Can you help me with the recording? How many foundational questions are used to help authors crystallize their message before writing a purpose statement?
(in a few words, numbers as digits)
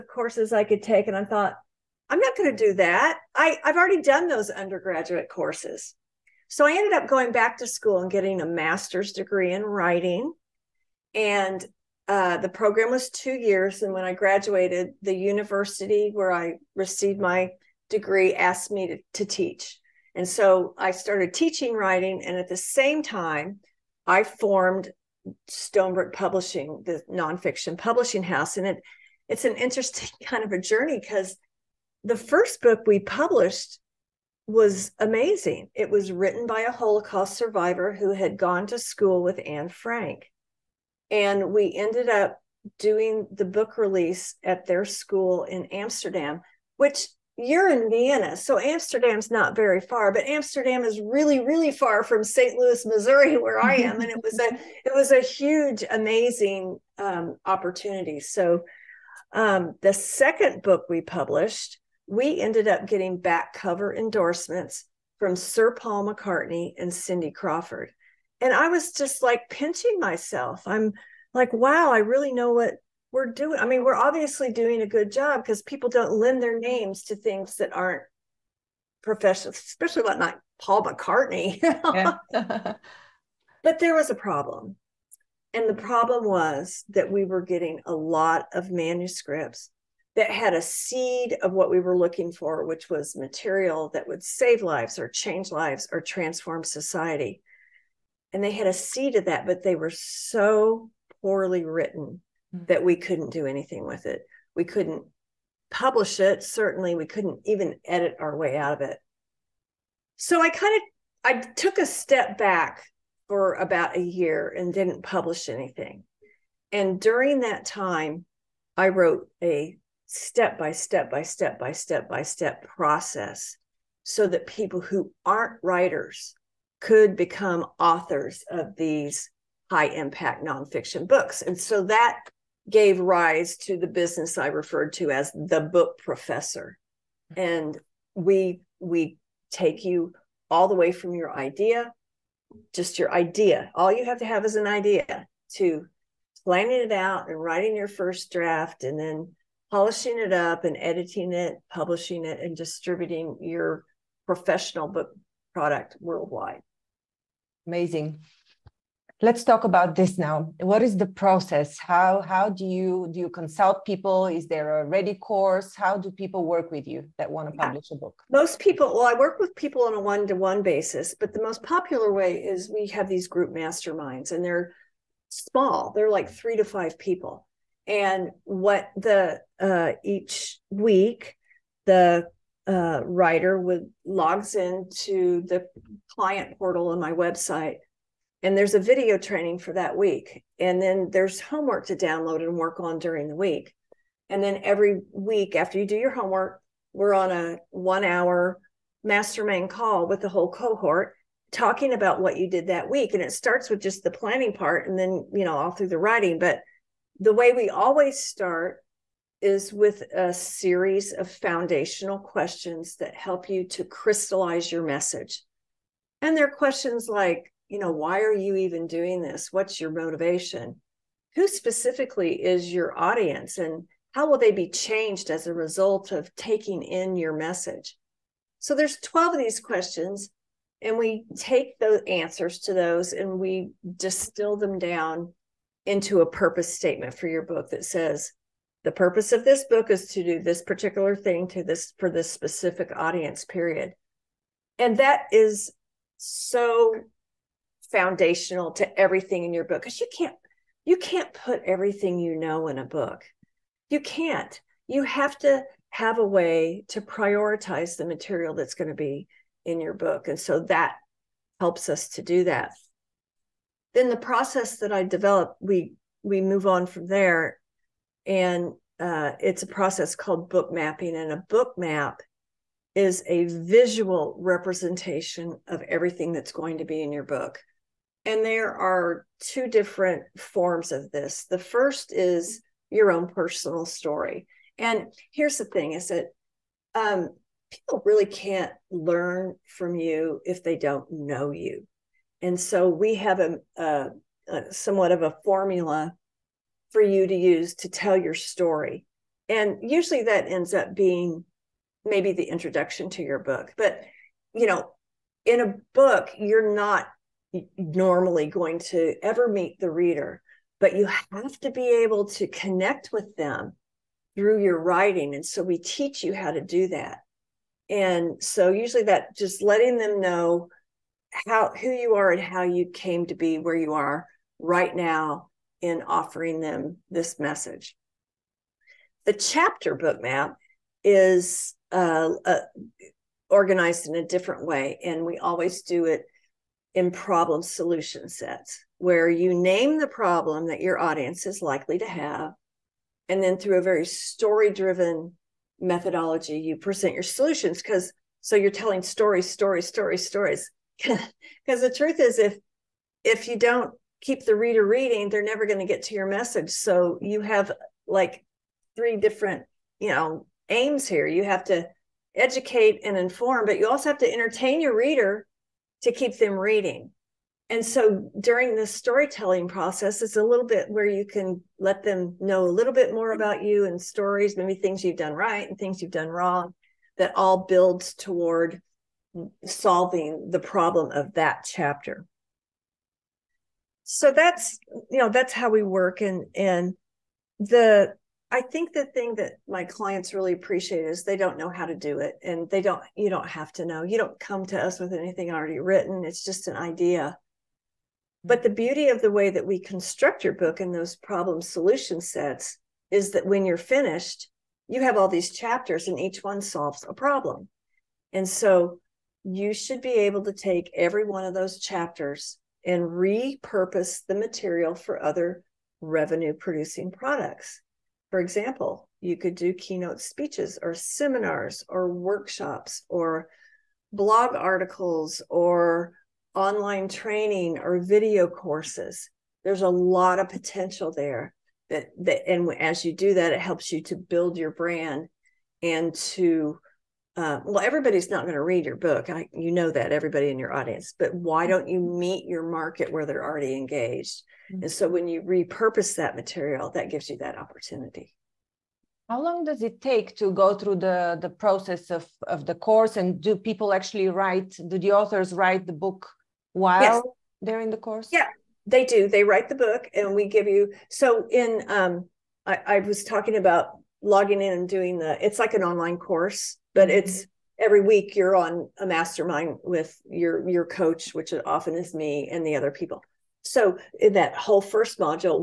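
12.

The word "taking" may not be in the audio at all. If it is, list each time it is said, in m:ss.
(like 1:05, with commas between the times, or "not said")
3:46.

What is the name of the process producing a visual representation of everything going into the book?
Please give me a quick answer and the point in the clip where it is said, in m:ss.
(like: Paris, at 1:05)
book mapping, at 4:30.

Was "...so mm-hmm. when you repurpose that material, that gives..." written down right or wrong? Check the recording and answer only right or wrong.
right.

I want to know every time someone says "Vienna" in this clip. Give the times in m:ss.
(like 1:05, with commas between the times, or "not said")
0:47.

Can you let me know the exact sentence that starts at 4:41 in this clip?
The first is your own personal story.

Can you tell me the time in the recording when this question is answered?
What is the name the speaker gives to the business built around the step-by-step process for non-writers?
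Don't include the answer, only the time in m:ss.
2:15.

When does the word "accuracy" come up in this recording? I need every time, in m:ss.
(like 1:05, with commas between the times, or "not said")
not said.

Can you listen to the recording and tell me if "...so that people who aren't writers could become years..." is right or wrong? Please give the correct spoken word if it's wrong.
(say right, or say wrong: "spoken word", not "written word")
wrong: "authors", not "years".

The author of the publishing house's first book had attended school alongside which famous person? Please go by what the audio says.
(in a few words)
Anne Frank.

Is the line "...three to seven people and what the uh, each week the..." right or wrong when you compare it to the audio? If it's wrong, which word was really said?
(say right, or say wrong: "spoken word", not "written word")
wrong: "five", not "seven".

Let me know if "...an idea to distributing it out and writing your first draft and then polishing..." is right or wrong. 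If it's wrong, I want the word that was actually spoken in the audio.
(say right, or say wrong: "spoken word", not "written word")
wrong: "planning", not "distributing".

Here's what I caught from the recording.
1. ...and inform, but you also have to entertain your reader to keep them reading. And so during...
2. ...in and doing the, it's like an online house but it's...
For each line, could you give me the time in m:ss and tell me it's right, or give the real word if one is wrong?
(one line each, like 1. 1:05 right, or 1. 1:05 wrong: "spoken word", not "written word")
1. 6:03 right
2. 7:44 wrong: "course", not "house".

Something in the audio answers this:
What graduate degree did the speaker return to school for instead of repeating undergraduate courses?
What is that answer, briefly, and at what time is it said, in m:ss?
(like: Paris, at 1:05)
master's degree in writing, at 0:08.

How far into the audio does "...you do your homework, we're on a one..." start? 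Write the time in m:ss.
3:15.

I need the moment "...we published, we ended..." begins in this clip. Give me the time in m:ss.
1:00.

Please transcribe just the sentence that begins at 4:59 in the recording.
And usually that ends up being maybe the introduction to your book.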